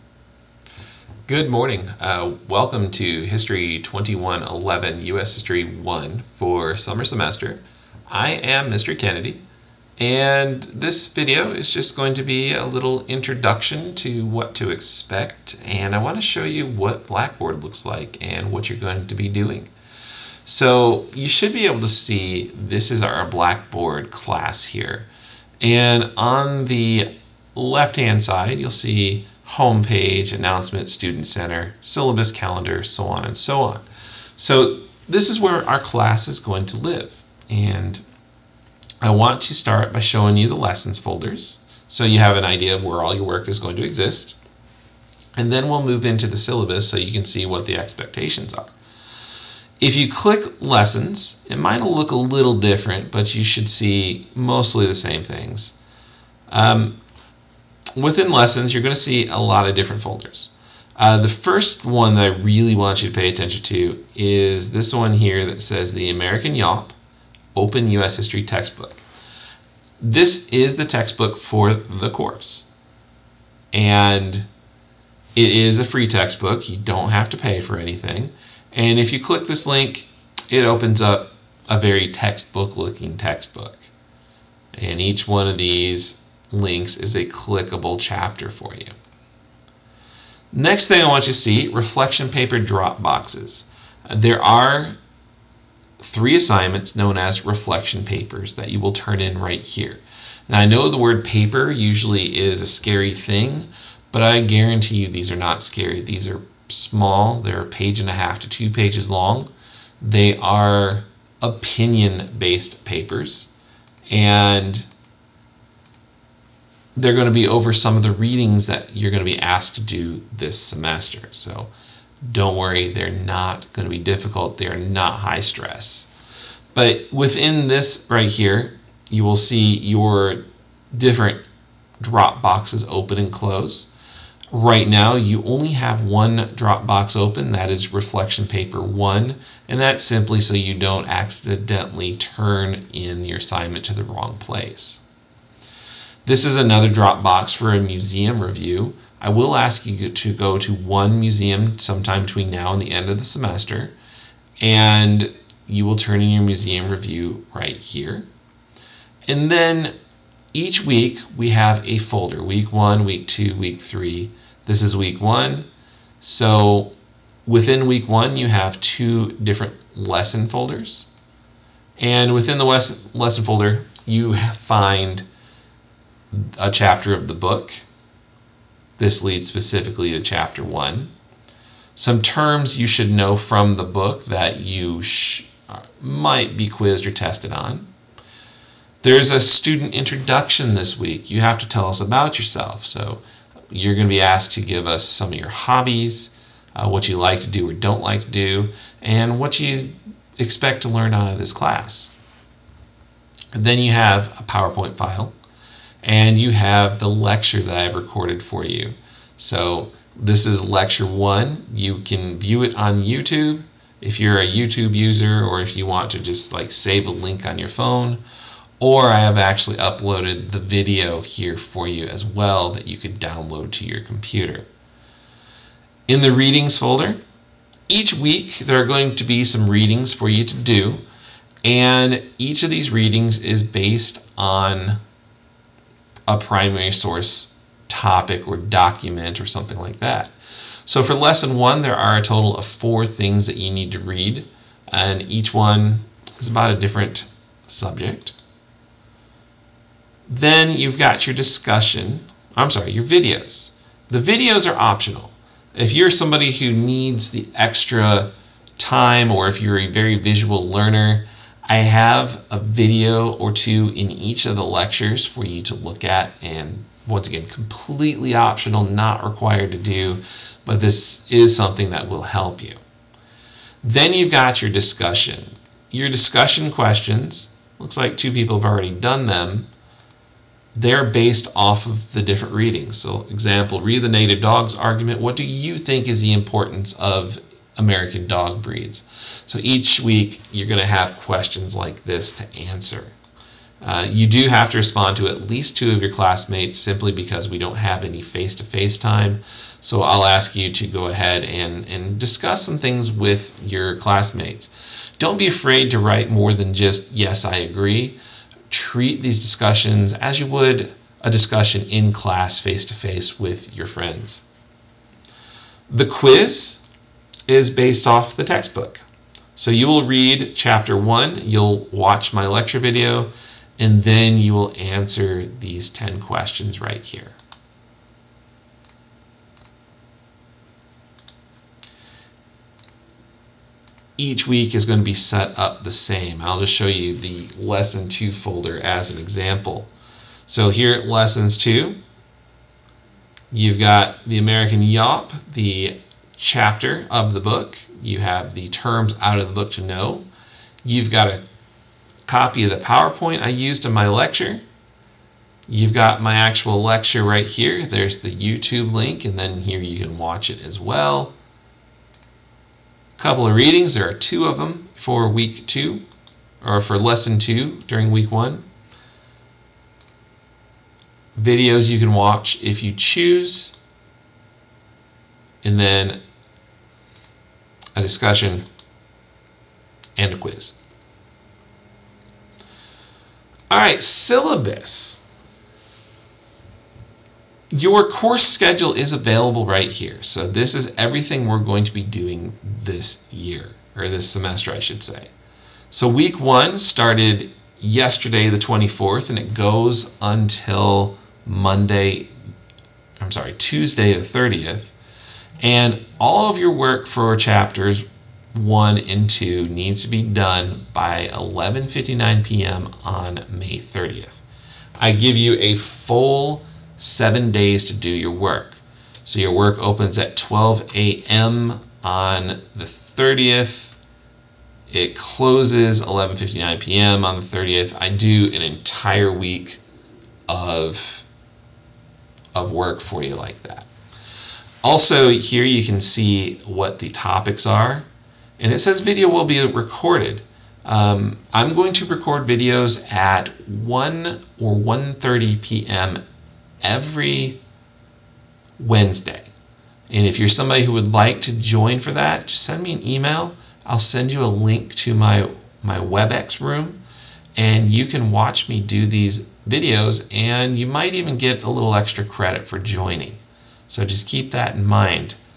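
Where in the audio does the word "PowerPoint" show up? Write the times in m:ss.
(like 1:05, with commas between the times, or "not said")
3:24, 5:52.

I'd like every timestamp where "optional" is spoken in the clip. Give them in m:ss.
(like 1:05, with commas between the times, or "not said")
4:14, 4:28.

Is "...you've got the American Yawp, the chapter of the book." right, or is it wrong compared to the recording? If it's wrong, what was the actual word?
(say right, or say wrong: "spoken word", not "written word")
right.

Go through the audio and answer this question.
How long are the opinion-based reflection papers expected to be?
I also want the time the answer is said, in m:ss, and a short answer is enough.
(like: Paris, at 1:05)
A page and a half to two pages, at 1:47.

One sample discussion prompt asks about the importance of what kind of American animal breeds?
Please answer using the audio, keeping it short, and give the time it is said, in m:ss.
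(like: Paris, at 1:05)
Dogs, at 4:48.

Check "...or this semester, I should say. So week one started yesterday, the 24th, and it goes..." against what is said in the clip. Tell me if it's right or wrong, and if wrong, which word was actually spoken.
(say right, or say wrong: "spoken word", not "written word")
right.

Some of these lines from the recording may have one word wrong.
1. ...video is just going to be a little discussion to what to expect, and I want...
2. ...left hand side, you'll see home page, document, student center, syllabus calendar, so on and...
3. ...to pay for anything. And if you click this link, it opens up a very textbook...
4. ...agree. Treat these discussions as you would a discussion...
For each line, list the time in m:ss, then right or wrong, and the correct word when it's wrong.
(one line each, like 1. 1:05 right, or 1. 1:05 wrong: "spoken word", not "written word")
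1. 0:11 wrong: "introduction", not "discussion"
2. 0:27 wrong: "announcement", not "document"
3. 1:17 right
4. 5:07 right.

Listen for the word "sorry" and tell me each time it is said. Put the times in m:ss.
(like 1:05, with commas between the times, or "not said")
4:12, 6:43.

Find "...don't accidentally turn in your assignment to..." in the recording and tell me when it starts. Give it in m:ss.
2:20.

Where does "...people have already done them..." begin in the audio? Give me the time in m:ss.
4:38.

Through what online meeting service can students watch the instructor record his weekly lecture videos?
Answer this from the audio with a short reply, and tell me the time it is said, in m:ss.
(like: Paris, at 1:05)
WebEx, at 7:35.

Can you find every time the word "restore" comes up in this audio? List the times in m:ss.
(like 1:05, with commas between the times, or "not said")
not said.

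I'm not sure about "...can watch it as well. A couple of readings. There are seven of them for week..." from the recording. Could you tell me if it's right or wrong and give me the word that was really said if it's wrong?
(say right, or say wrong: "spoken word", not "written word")
wrong: "two", not "seven".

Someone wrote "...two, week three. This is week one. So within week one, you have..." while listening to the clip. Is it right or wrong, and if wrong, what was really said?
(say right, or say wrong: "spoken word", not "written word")
right.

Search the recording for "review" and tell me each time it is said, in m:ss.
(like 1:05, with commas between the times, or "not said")
2:28, 2:36.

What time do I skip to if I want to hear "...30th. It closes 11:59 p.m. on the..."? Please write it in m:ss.
7:02.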